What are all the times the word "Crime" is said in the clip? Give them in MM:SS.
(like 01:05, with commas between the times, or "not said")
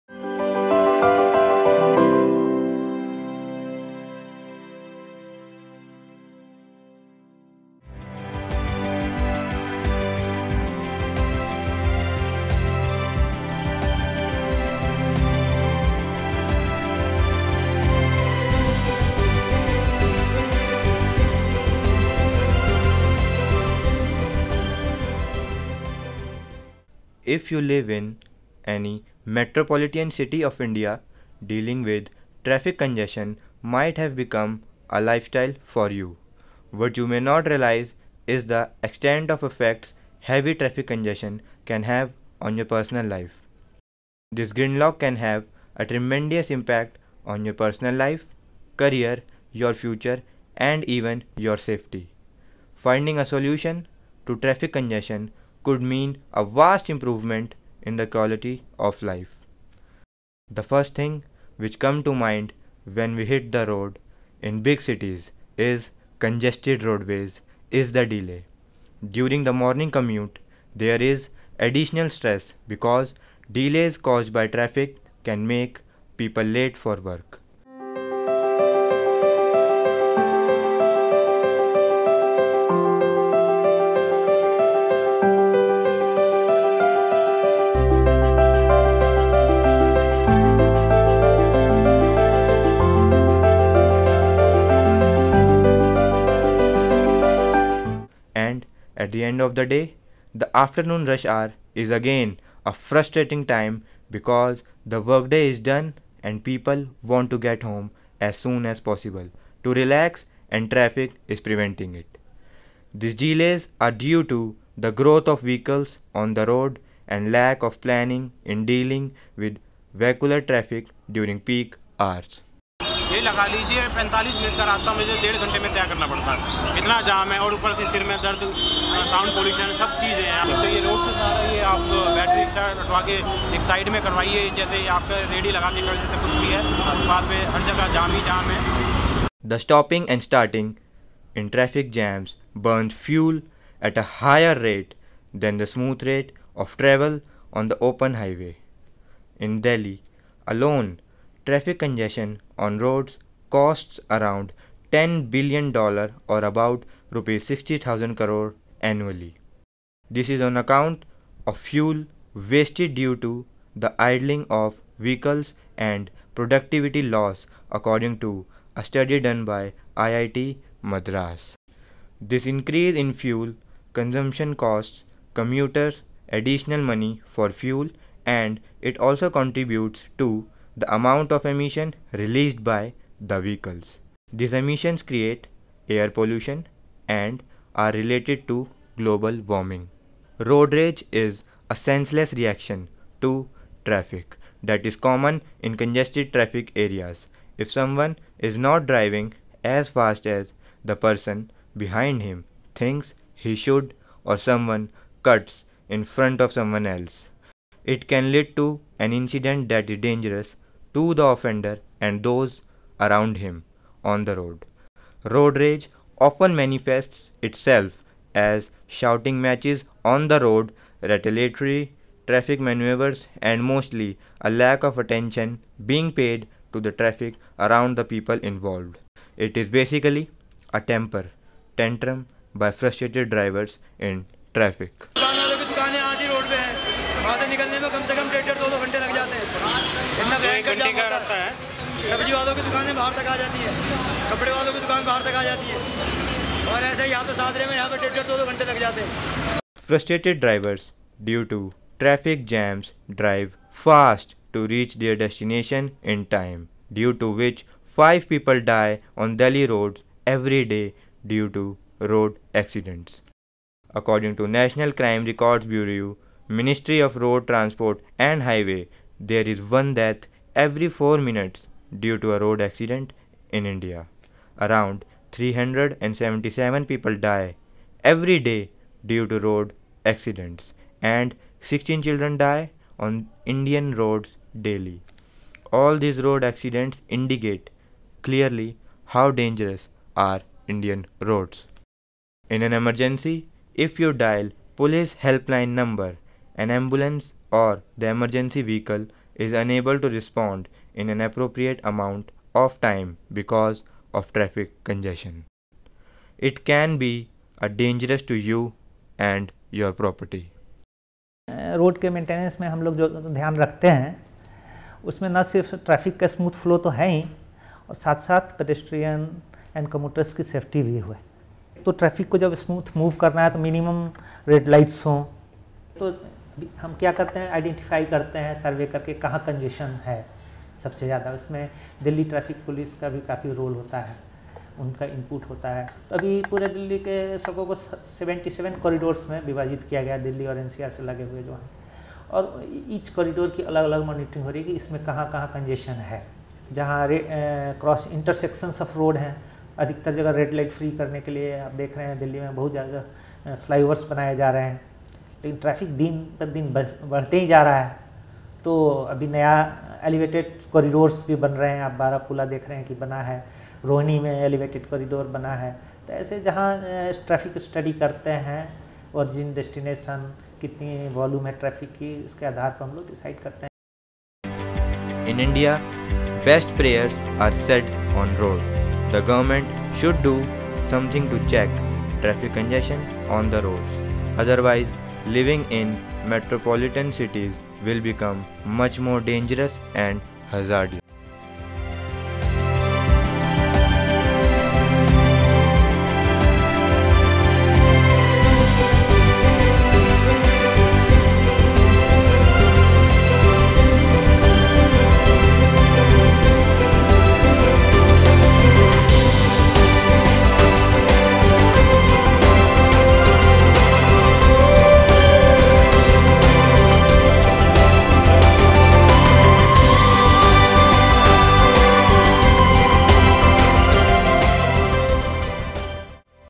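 04:25.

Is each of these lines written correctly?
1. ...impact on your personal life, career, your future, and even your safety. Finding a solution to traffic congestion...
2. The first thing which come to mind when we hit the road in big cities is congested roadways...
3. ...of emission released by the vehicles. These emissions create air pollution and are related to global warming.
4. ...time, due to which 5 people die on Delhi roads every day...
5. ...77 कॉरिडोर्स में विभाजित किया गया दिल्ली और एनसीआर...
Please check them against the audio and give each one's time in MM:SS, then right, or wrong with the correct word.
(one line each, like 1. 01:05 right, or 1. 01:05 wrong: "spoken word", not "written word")
1. 00:46 right
2. 01:00 right
3. 03:01 right
4. 04:16 right
5. 05:37 right.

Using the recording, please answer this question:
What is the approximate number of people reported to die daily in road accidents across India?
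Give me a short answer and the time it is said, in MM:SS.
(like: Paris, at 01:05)
377, at 04:35.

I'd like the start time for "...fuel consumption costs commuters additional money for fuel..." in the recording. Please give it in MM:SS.
02:53.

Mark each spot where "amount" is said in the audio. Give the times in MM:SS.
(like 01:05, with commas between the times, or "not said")
03:00, 05:01.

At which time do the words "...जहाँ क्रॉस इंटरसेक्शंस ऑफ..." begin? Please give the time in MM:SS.
05:46.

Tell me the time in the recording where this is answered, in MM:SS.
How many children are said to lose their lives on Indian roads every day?
04:41.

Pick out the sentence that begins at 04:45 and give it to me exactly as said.
All these road accidents indicate clearly how dangerous are Indian roads.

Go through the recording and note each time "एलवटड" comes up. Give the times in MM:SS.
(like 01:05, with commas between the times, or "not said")
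06:00, 06:04.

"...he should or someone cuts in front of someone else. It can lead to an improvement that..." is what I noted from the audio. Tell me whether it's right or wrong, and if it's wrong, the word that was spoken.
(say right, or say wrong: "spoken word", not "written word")
wrong: "incident", not "improvement".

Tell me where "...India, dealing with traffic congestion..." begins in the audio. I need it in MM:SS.
00:30.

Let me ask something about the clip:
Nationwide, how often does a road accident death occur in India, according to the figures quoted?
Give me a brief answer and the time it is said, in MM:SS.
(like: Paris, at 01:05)
every 4 minutes, at 04:30.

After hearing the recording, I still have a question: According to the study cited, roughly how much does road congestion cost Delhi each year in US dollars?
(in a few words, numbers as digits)
$10 billion.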